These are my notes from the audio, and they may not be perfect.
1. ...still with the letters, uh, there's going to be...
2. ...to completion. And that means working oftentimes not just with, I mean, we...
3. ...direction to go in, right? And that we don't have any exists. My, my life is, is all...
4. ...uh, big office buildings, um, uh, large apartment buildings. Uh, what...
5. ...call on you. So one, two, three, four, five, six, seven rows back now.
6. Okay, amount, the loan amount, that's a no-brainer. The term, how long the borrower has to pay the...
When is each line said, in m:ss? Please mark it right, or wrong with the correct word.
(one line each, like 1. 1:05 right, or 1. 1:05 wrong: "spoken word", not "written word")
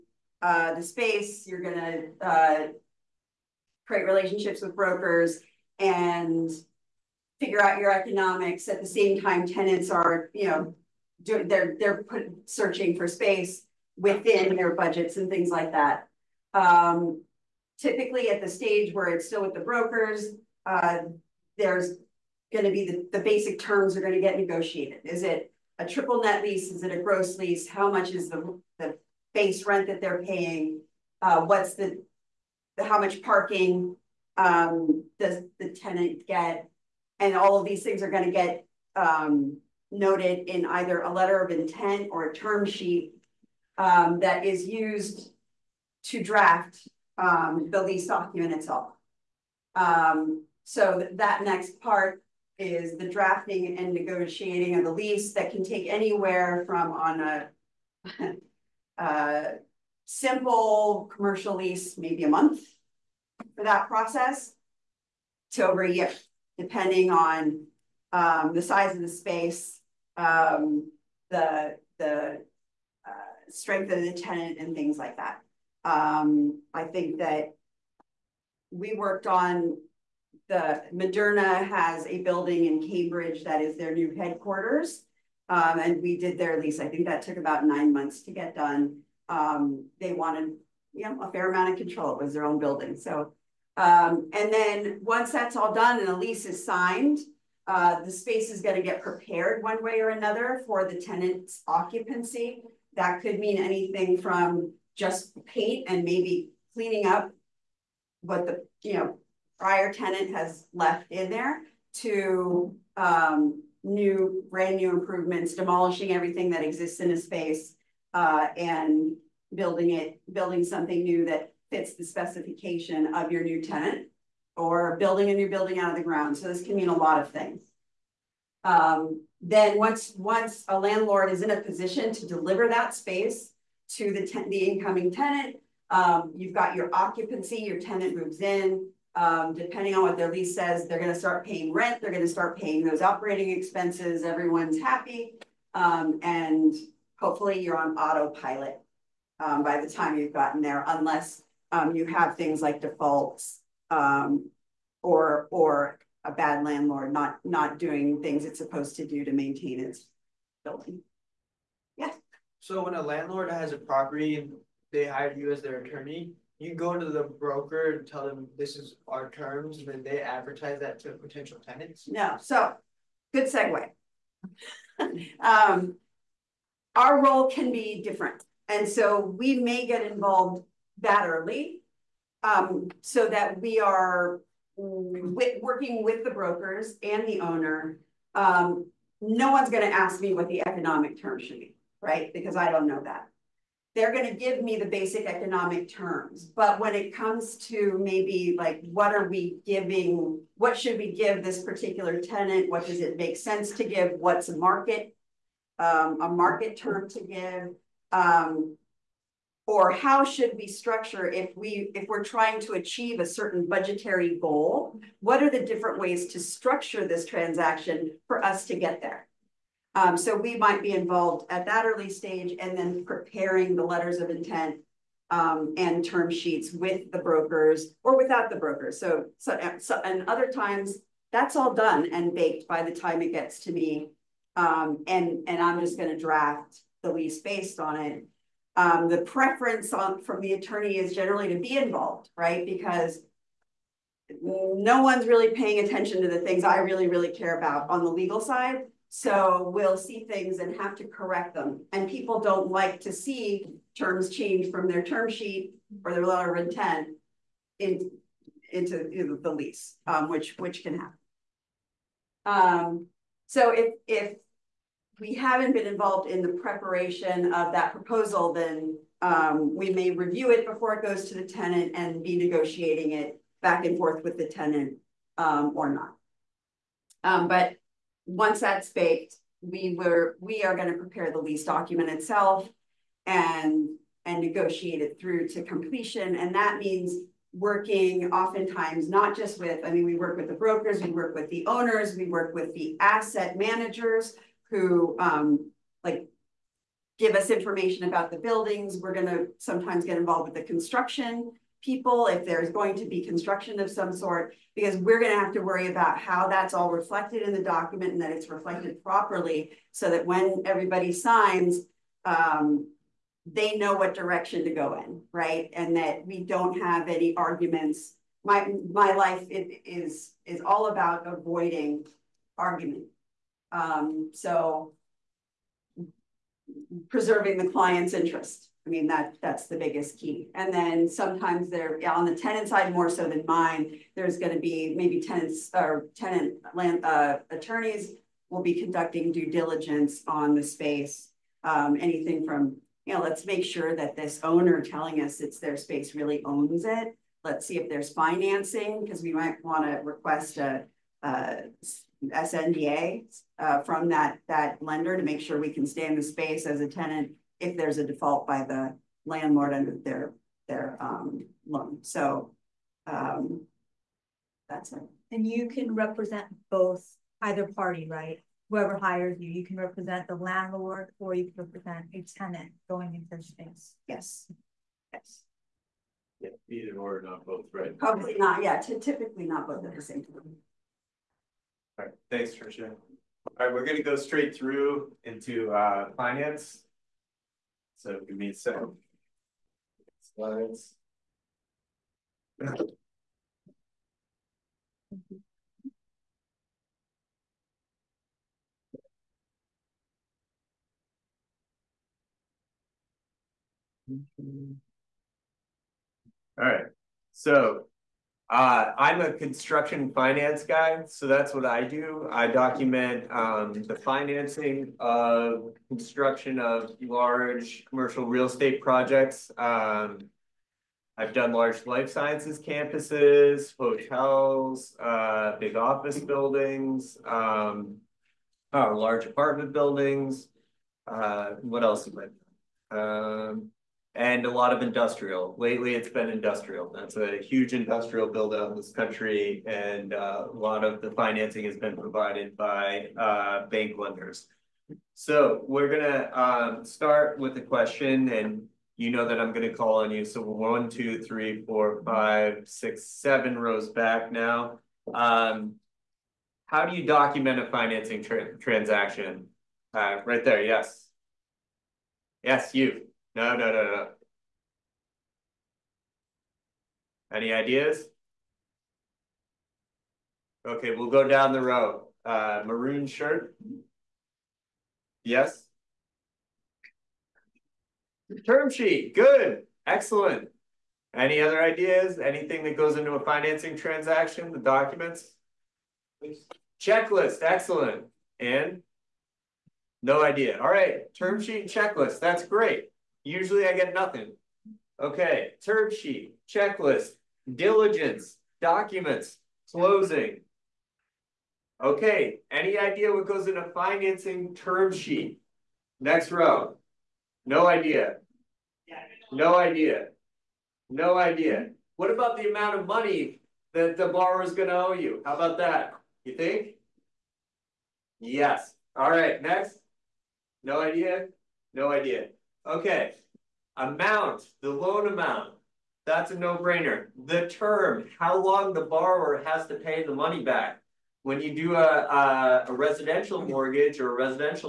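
1. 0:19 wrong: "brokers", not "letters"
2. 4:45 right
3. 5:14 wrong: "arguments", not "exists"
4. 7:05 right
5. 7:29 right
6. 8:42 right.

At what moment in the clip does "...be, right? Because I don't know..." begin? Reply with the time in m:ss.
3:11.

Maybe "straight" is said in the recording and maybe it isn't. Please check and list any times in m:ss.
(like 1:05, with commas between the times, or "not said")
6:24.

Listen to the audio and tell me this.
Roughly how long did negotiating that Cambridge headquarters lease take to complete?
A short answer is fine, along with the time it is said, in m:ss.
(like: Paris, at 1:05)
9 months, at 1:27.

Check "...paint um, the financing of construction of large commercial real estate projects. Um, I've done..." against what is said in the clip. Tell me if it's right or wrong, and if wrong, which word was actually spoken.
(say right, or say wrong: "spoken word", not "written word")
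wrong: "document", not "paint".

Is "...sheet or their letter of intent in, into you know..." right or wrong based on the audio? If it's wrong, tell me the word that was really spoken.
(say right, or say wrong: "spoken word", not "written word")
right.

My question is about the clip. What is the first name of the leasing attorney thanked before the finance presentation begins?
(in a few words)
Tricia.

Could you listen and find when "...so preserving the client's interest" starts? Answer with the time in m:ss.
5:24.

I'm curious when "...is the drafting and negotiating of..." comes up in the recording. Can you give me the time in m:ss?
0:52.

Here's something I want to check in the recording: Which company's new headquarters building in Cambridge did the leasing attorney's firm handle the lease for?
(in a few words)
Moderna.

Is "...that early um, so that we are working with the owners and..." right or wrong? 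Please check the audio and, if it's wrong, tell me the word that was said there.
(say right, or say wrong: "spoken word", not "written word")
wrong: "brokers", not "owners".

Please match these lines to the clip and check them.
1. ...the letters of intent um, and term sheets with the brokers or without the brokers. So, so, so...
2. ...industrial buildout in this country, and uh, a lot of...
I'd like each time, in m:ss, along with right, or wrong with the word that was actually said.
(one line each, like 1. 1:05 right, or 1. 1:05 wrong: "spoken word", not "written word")
1. 3:43 right
2. 7:17 right.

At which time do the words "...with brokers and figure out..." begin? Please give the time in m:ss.
0:04.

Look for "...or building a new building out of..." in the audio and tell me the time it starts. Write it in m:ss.
2:04.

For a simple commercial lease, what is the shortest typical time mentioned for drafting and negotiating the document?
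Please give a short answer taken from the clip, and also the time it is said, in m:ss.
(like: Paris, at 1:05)
a month, at 1:02.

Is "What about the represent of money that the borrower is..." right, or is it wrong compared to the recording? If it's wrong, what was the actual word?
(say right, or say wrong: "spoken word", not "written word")
wrong: "amount", not "represent".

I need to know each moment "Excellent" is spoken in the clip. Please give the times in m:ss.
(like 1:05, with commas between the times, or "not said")
7:59, 8:07.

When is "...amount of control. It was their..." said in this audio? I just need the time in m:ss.
1:31.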